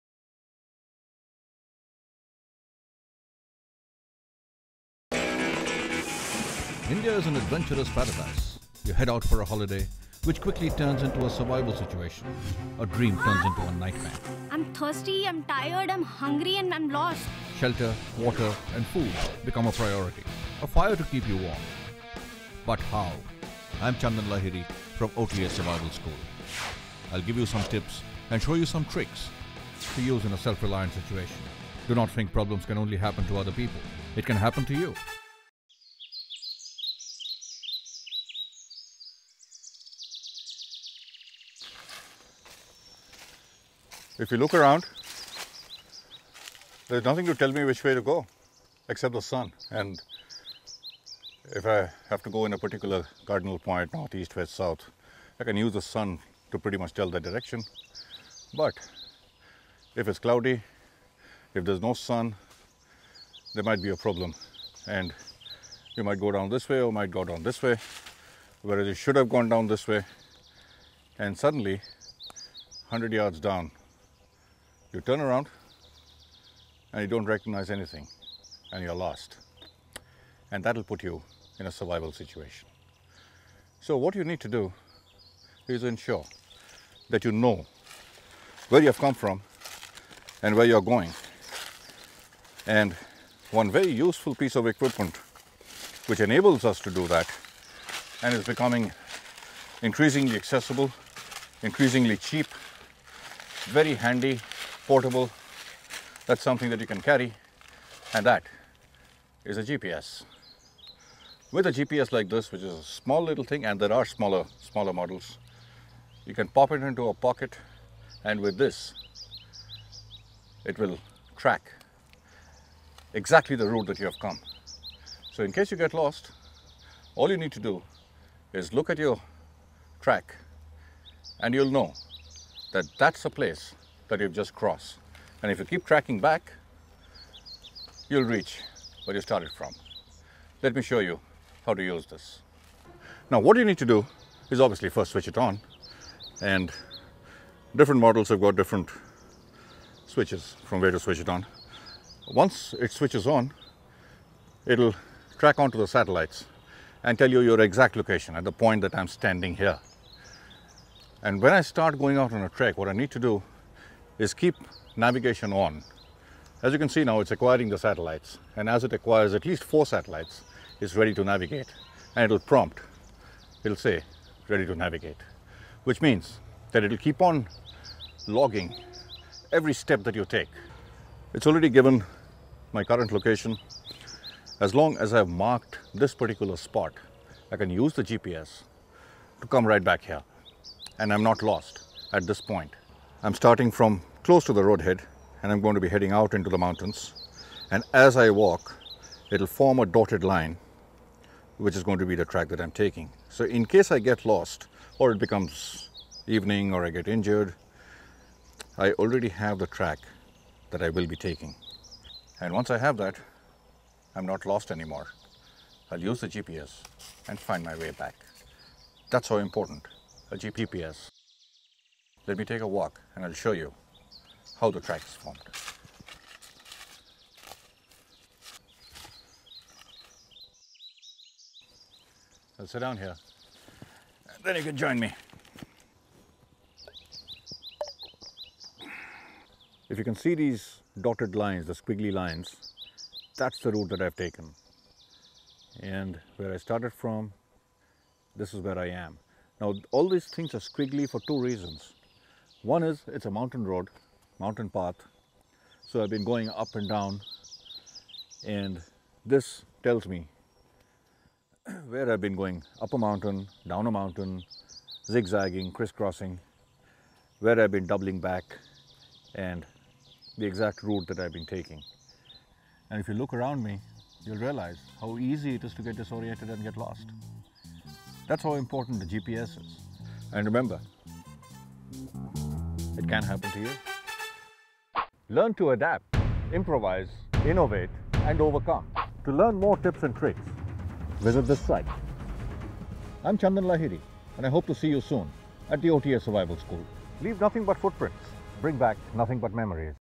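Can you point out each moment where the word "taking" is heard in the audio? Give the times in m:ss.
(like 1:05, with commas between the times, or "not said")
3:22, 3:31, 4:31.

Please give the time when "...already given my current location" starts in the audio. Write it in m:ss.
3:01.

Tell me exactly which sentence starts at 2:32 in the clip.
Once it switches on, it'll track onto the satellites and tell you your exact location at the point that I'm standing here.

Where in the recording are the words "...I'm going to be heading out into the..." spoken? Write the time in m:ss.
3:15.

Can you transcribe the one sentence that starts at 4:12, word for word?
One is it's a mountain road mountain path.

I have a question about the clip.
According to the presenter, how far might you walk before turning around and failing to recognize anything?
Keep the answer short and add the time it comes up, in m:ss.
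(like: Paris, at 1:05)
100 yards, at 1:12.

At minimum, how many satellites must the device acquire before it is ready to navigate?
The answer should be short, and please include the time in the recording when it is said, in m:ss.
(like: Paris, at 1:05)
4, at 2:49.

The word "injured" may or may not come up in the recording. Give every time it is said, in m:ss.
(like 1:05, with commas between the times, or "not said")
3:27.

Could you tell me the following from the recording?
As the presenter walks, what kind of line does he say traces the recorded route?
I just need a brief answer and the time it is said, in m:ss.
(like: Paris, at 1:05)
dotted line, at 3:19.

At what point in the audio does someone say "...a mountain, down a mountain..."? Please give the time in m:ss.
4:22.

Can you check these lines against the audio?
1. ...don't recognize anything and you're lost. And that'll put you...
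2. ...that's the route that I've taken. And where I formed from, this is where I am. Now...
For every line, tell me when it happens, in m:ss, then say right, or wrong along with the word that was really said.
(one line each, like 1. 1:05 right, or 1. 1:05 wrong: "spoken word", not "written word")
1. 1:17 right
2. 4:03 wrong: "started", not "formed".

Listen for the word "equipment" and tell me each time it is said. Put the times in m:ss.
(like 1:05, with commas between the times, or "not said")
1:34.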